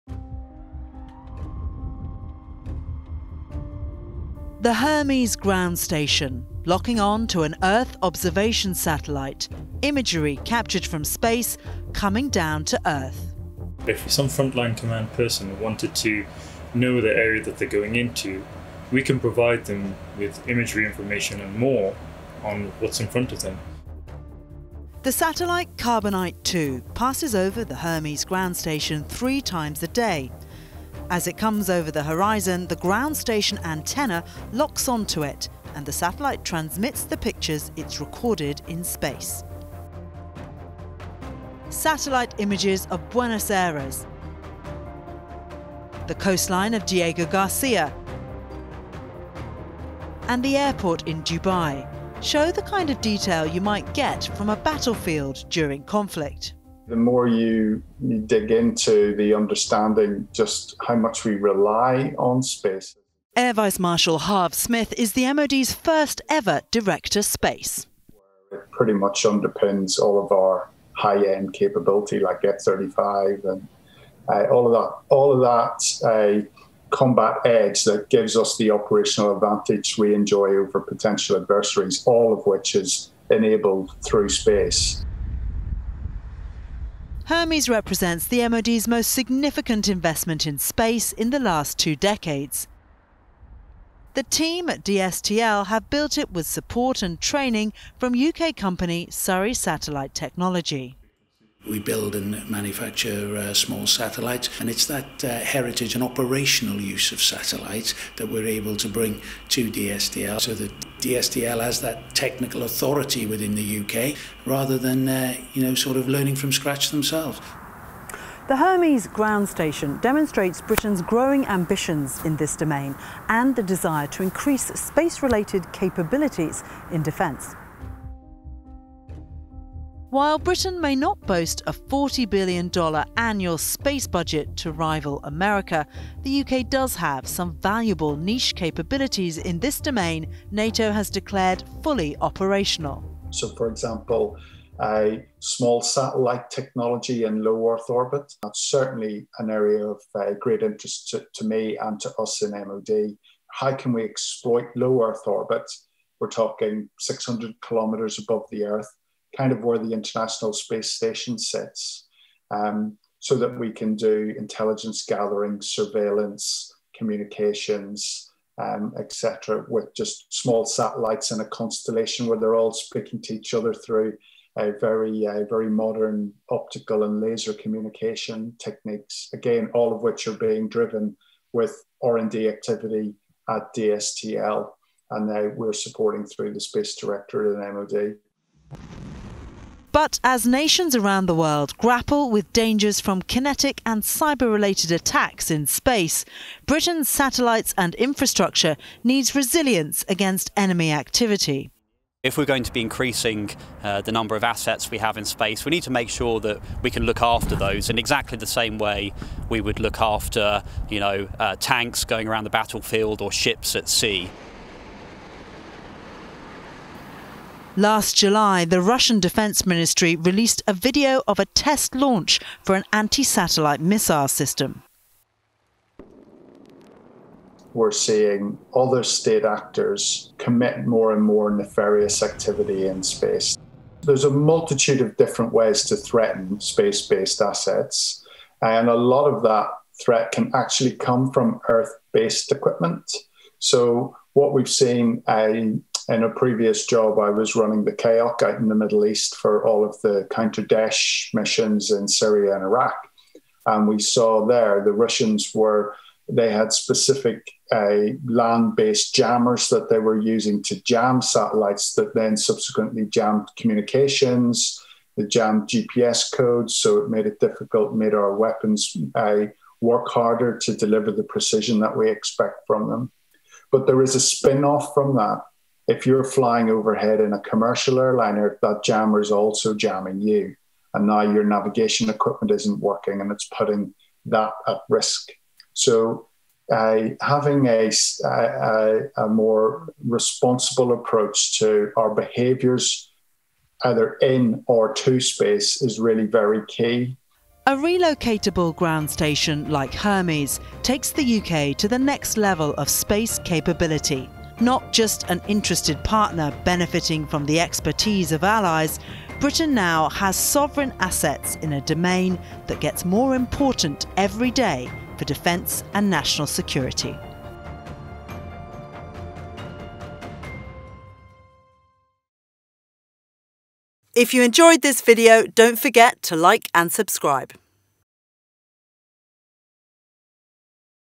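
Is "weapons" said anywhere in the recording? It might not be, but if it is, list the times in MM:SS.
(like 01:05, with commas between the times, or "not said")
04:28.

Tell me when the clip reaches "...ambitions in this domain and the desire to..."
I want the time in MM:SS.
02:01.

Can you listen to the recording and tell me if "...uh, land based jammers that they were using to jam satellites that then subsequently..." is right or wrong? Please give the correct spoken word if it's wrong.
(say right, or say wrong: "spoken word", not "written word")
right.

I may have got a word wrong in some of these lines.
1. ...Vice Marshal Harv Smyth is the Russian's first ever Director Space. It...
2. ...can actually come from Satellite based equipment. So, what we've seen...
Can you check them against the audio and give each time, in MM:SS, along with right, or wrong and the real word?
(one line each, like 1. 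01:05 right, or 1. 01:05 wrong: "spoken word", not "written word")
1. 01:03 wrong: "MOD", not "Russian"
2. 04:00 wrong: "Earth", not "Satellite".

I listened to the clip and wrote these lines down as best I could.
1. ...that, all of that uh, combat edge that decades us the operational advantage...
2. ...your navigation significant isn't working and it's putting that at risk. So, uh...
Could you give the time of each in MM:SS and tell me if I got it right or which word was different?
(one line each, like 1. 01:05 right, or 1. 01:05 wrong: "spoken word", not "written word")
1. 01:14 wrong: "gives", not "decades"
2. 04:41 wrong: "equipment", not "significant".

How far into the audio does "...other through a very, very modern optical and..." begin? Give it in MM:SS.
02:53.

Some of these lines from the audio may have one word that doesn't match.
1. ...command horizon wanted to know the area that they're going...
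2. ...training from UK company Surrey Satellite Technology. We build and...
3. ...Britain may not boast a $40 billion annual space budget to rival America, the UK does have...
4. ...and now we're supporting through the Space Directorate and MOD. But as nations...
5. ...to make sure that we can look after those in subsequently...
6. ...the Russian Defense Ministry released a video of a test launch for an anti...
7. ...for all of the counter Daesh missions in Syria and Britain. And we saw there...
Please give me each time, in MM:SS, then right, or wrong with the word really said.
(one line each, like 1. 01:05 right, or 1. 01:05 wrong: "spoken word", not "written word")
1. 00:14 wrong: "person", not "horizon"
2. 01:37 right
3. 02:10 right
4. 03:05 right
5. 03:25 wrong: "exactly", not "subsequently"
6. 03:38 right
7. 04:09 wrong: "Iraq", not "Britain".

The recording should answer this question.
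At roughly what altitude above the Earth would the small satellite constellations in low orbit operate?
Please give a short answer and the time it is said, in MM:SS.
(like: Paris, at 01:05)
600 kilometres, at 02:36.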